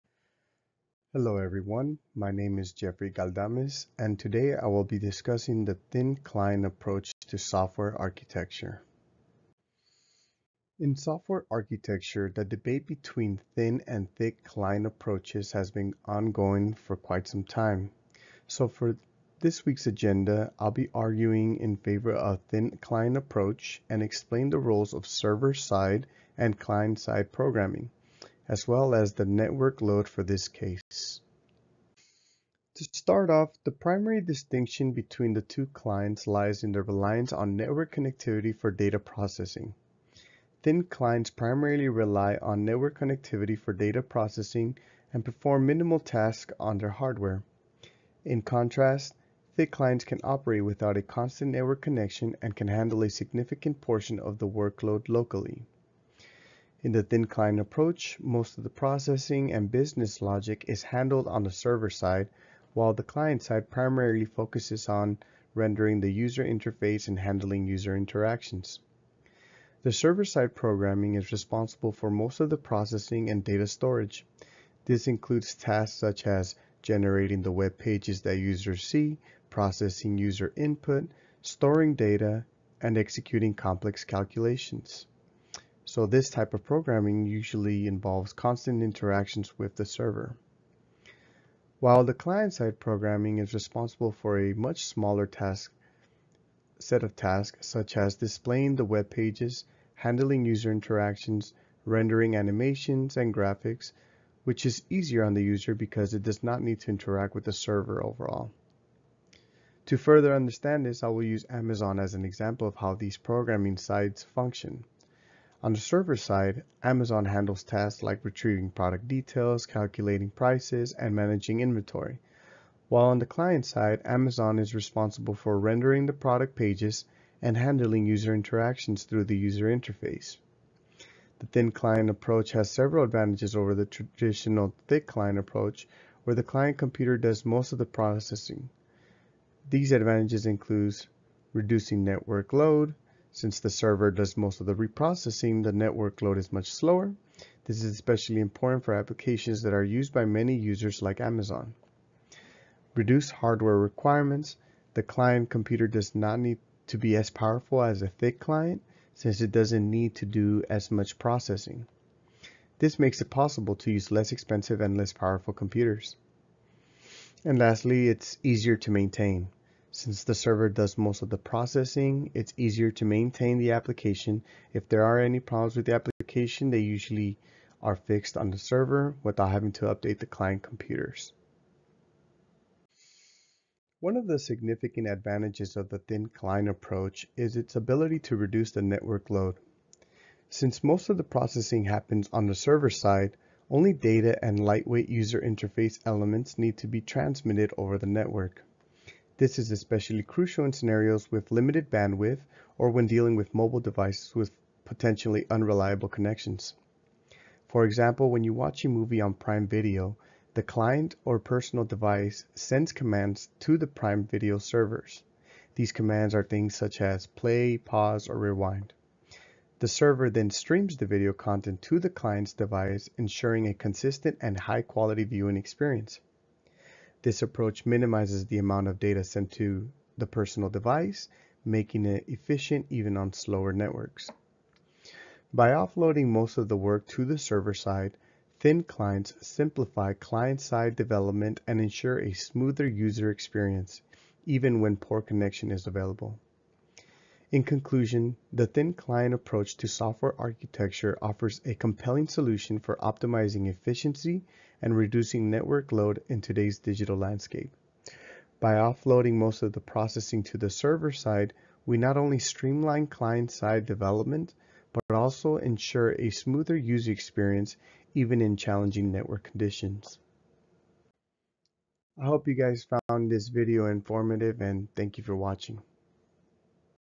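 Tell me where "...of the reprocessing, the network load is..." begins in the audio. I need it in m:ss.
2:24.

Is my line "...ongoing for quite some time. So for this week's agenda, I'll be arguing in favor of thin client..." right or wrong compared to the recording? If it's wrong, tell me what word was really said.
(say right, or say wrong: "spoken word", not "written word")
right.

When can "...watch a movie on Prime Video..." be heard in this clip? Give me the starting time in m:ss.
3:28.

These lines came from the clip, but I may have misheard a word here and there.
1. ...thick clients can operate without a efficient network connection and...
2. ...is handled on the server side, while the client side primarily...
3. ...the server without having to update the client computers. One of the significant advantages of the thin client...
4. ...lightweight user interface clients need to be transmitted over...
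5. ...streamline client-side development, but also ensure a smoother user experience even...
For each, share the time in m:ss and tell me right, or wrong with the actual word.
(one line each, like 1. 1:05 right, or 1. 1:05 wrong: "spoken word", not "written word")
1. 0:49 wrong: "constant", not "efficient"
2. 1:00 right
3. 2:58 right
4. 3:14 wrong: "elements", not "clients"
5. 4:22 right.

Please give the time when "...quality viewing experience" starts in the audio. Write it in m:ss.
3:44.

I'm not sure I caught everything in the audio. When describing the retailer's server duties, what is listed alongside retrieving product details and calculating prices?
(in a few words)
managing inventory.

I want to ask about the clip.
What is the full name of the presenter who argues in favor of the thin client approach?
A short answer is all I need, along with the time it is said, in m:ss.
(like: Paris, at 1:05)
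Jeffery Galdamez, at 0:02.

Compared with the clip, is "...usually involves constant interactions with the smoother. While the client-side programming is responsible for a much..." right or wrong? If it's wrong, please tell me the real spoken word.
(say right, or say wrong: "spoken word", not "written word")
wrong: "server", not "smoother".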